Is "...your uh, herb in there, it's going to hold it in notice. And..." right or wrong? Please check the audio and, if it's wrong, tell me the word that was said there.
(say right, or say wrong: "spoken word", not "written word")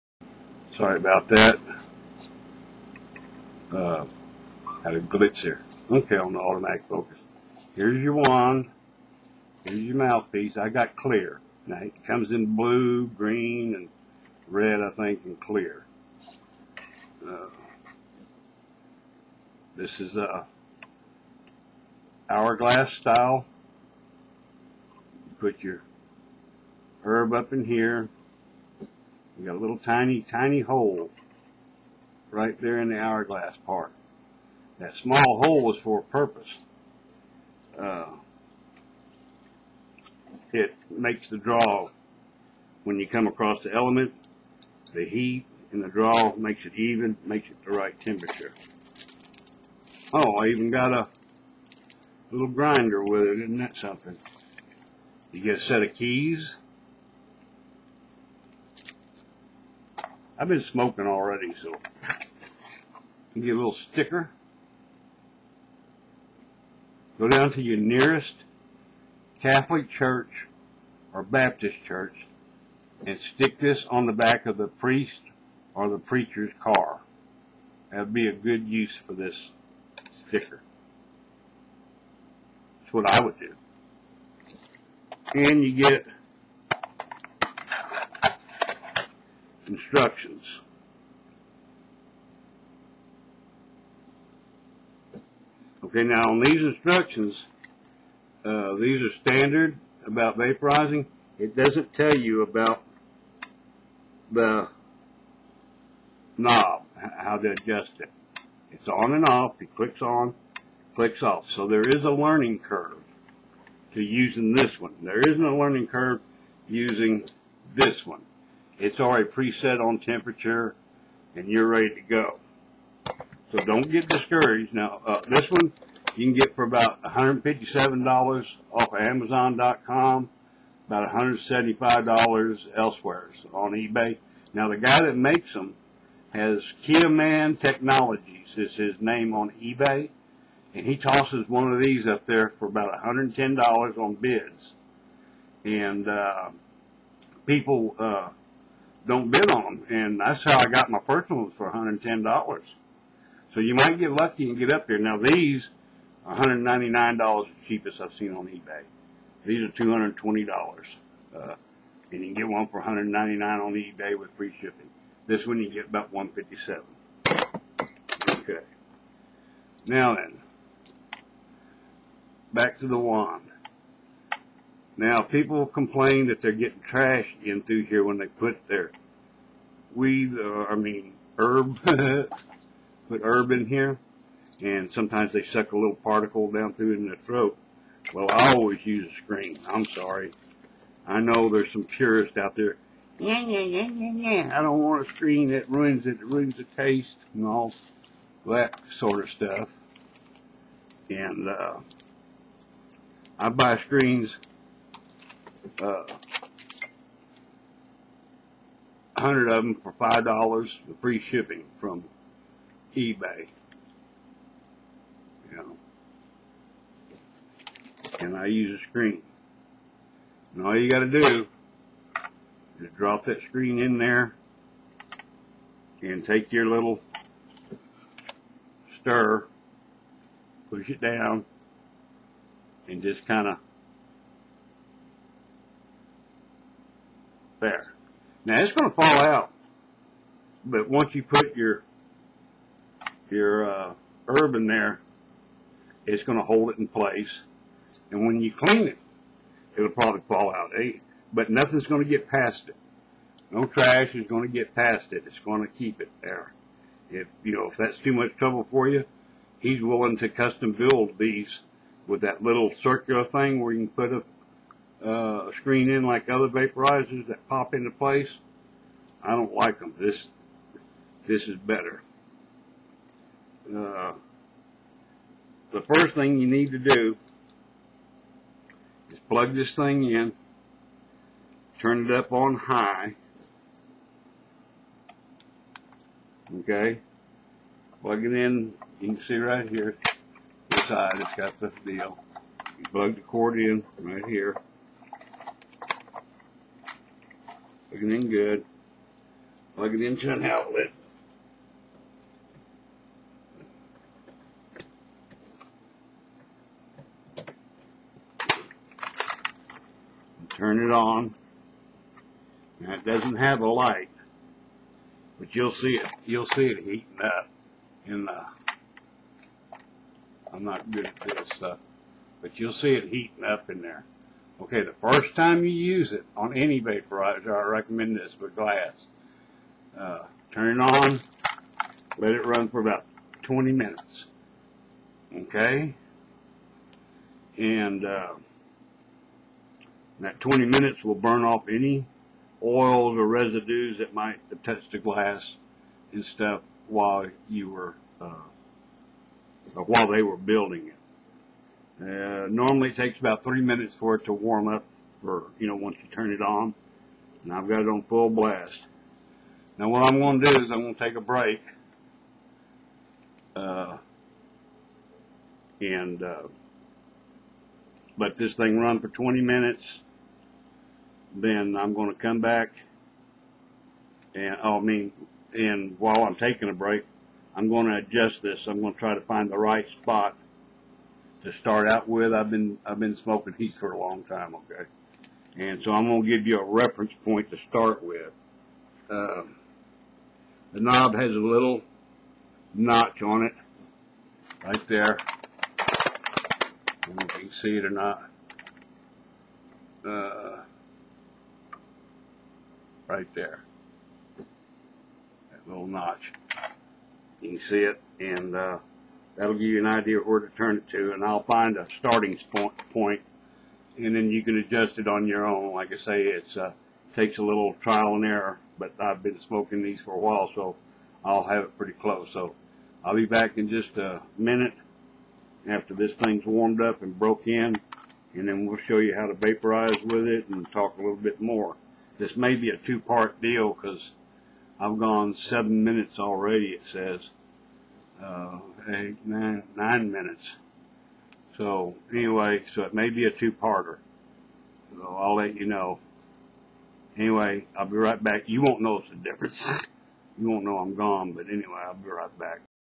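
wrong: "place", not "notice".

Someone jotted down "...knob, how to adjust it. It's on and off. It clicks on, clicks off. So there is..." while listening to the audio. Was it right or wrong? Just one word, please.
right.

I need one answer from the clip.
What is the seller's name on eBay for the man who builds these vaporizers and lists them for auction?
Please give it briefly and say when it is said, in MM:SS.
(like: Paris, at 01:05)
Kiaman Technologies, at 02:16.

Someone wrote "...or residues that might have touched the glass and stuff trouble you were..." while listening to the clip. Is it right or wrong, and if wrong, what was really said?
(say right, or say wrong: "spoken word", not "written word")
wrong: "while", not "trouble".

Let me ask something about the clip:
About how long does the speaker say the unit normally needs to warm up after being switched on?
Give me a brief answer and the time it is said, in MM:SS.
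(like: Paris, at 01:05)
three minutes, at 05:53.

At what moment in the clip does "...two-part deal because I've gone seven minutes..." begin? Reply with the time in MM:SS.
07:12.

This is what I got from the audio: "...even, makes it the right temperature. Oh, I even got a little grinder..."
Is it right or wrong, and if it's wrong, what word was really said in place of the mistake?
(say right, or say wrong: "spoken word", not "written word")
right.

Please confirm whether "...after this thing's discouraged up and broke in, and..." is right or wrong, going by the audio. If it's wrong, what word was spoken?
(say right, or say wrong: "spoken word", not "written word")
wrong: "warmed", not "discouraged".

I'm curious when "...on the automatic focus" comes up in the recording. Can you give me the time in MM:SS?
00:06.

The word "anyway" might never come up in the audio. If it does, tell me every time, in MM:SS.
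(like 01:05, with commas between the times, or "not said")
07:22, 07:27, 07:31.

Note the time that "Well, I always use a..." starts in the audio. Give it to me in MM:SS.
03:08.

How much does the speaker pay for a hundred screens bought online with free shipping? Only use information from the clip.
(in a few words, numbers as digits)
five dollars.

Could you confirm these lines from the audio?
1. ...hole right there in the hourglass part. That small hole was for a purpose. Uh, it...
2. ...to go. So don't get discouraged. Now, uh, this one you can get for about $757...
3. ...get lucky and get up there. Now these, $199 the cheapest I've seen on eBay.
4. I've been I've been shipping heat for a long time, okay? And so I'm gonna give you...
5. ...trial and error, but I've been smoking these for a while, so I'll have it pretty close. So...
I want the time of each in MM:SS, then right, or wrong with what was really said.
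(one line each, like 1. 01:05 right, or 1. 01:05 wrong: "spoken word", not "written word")
1. 00:30 right
2. 02:01 wrong: "157", not "757"
3. 02:33 right
4. 06:22 wrong: "smoking", not "shipping"
5. 06:57 right.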